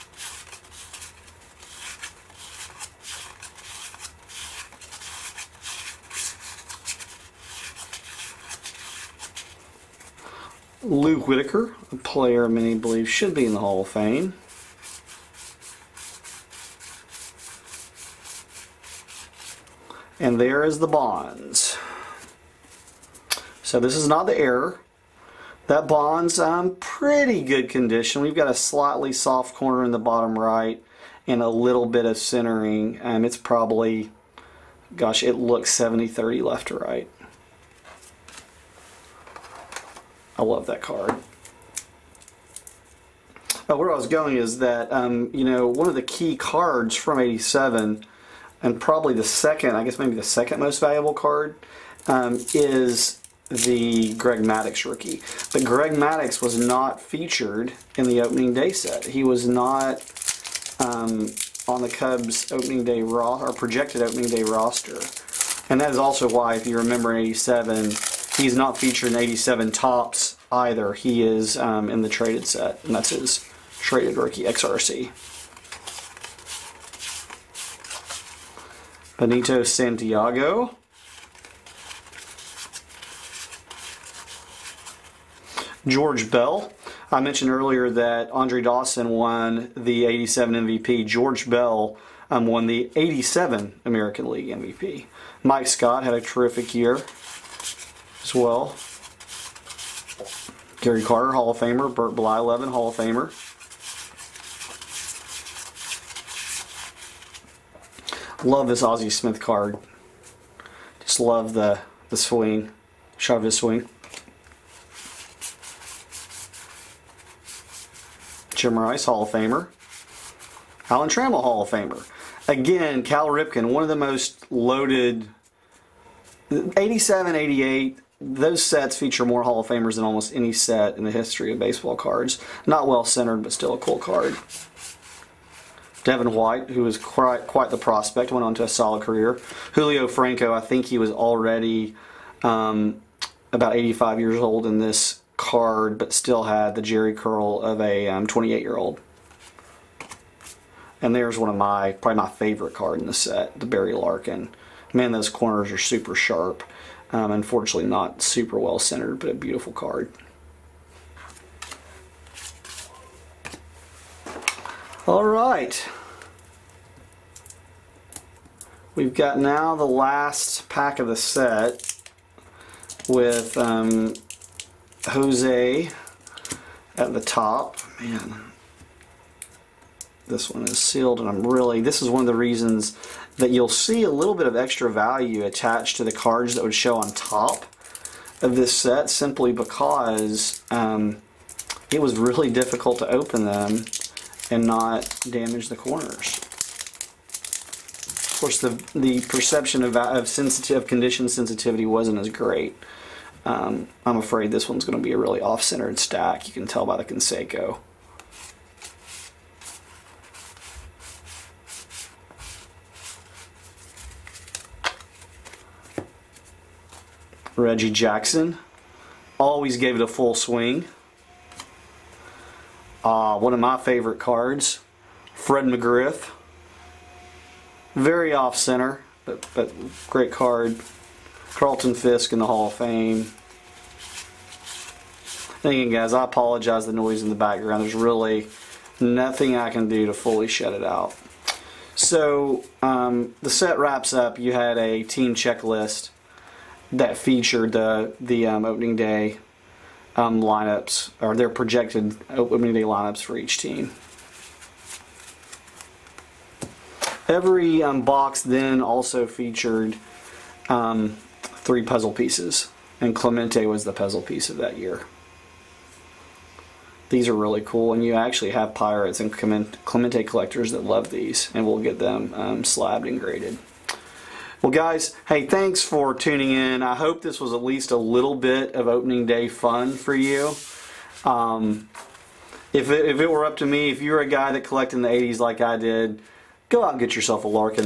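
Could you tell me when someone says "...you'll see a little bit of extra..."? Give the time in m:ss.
3:03.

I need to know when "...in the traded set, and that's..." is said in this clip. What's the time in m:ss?
1:11.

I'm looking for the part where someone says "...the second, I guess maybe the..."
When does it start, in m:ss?
0:49.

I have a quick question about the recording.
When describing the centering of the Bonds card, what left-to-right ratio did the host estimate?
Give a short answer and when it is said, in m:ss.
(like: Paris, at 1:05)
70-30, at 0:35.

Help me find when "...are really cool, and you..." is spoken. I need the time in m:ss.
4:27.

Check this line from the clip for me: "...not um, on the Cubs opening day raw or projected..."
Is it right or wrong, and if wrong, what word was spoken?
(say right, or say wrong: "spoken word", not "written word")
right.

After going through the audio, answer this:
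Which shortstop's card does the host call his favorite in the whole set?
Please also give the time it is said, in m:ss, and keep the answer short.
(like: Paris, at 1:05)
Barry Larkin, at 2:33.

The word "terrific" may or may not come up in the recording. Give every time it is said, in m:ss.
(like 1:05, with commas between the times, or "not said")
1:36.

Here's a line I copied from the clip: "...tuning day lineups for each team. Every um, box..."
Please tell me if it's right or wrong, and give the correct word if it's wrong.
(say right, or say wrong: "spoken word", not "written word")
wrong: "opening", not "tuning".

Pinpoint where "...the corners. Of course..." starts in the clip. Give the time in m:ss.
3:15.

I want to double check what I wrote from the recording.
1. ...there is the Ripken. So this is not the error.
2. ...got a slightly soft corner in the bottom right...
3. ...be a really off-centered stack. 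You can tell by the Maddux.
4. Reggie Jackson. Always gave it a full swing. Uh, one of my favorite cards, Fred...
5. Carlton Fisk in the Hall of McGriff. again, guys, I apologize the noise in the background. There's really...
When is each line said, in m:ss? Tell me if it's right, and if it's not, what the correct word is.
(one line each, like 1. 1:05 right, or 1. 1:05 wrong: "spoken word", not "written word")
1. 0:20 wrong: "Bonds", not "Ripken"
2. 0:28 right
3. 3:25 wrong: "Canseco", not "Maddux"
4. 3:37 right
5. 3:51 wrong: "Fame", not "McGriff".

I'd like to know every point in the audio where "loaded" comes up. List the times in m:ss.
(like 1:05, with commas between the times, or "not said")
2:04.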